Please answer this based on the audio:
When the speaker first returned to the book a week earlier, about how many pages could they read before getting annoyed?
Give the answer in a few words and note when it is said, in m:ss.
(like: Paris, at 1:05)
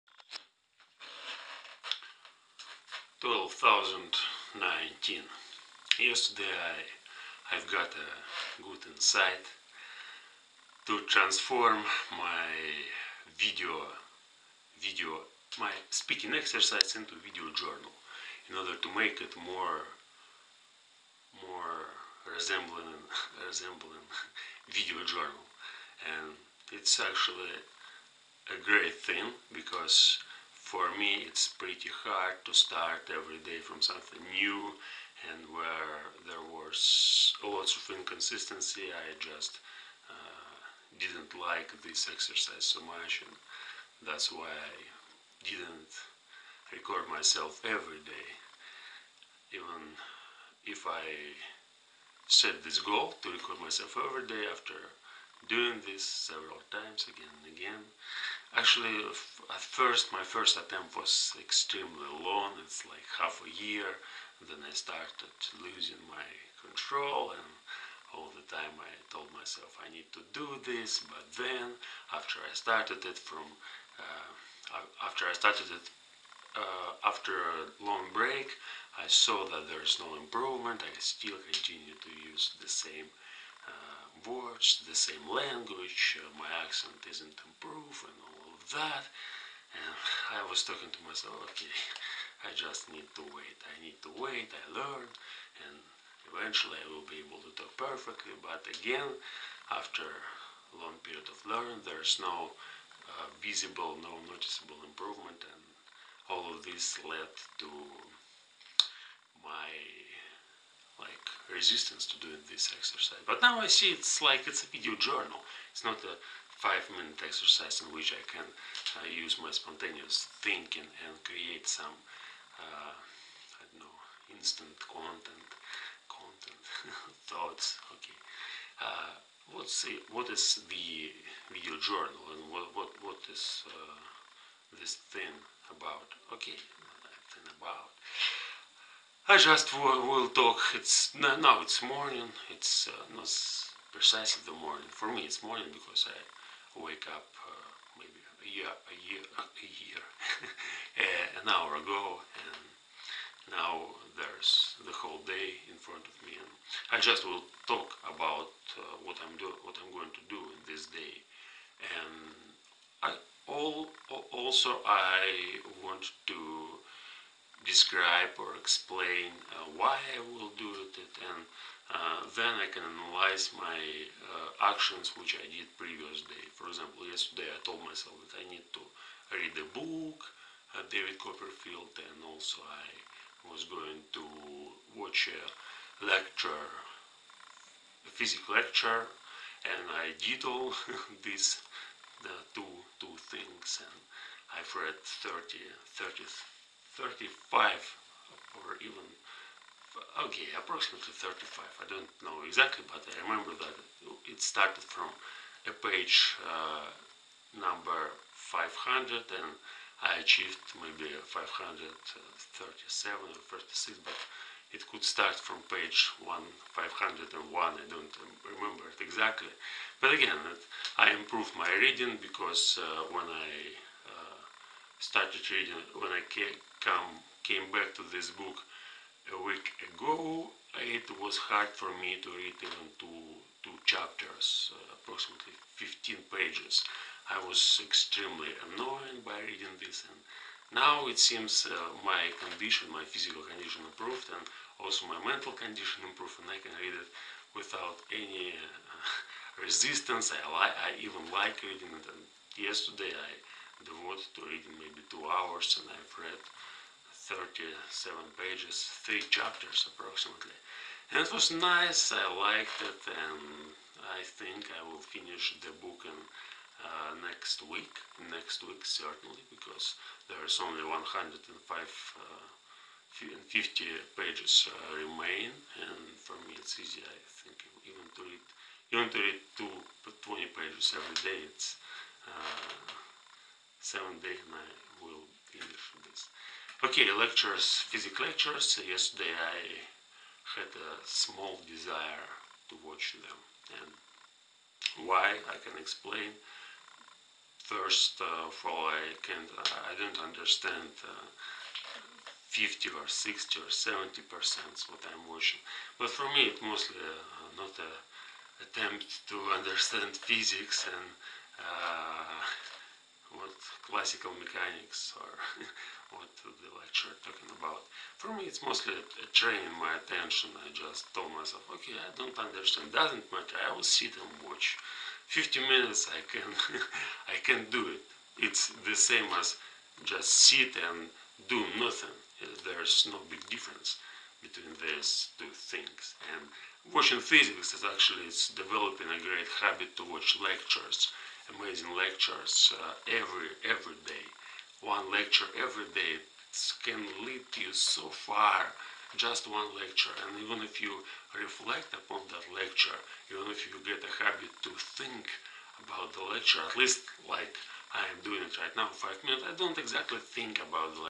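15, at 3:55.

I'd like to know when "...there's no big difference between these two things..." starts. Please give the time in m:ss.
5:32.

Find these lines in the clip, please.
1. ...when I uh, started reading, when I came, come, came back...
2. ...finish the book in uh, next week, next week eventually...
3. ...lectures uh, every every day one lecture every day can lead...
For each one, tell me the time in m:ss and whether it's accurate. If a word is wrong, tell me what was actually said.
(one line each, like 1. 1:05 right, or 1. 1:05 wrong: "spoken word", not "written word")
1. 3:43 right
2. 4:25 wrong: "certainly", not "eventually"
3. 5:41 right.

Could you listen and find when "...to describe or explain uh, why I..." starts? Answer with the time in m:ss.
2:46.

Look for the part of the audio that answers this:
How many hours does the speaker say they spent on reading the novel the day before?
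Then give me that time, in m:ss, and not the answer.
4:15.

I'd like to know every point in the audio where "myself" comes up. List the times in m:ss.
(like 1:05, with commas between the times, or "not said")
0:47, 0:53, 1:09, 1:31, 2:57, 5:21.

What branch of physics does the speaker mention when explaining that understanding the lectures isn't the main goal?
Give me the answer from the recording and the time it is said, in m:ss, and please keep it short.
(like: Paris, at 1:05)
classical mechanics, at 5:13.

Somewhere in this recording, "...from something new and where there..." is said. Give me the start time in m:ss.
0:33.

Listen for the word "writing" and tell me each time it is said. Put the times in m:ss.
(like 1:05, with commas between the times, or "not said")
not said.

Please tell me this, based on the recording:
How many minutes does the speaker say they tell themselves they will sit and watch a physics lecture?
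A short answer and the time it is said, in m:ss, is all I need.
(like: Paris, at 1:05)
50, at 5:25.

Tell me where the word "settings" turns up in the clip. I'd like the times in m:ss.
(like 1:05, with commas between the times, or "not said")
not said.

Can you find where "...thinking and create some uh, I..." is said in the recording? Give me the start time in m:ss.
2:00.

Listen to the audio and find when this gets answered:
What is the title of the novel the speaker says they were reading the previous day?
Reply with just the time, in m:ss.
3:00.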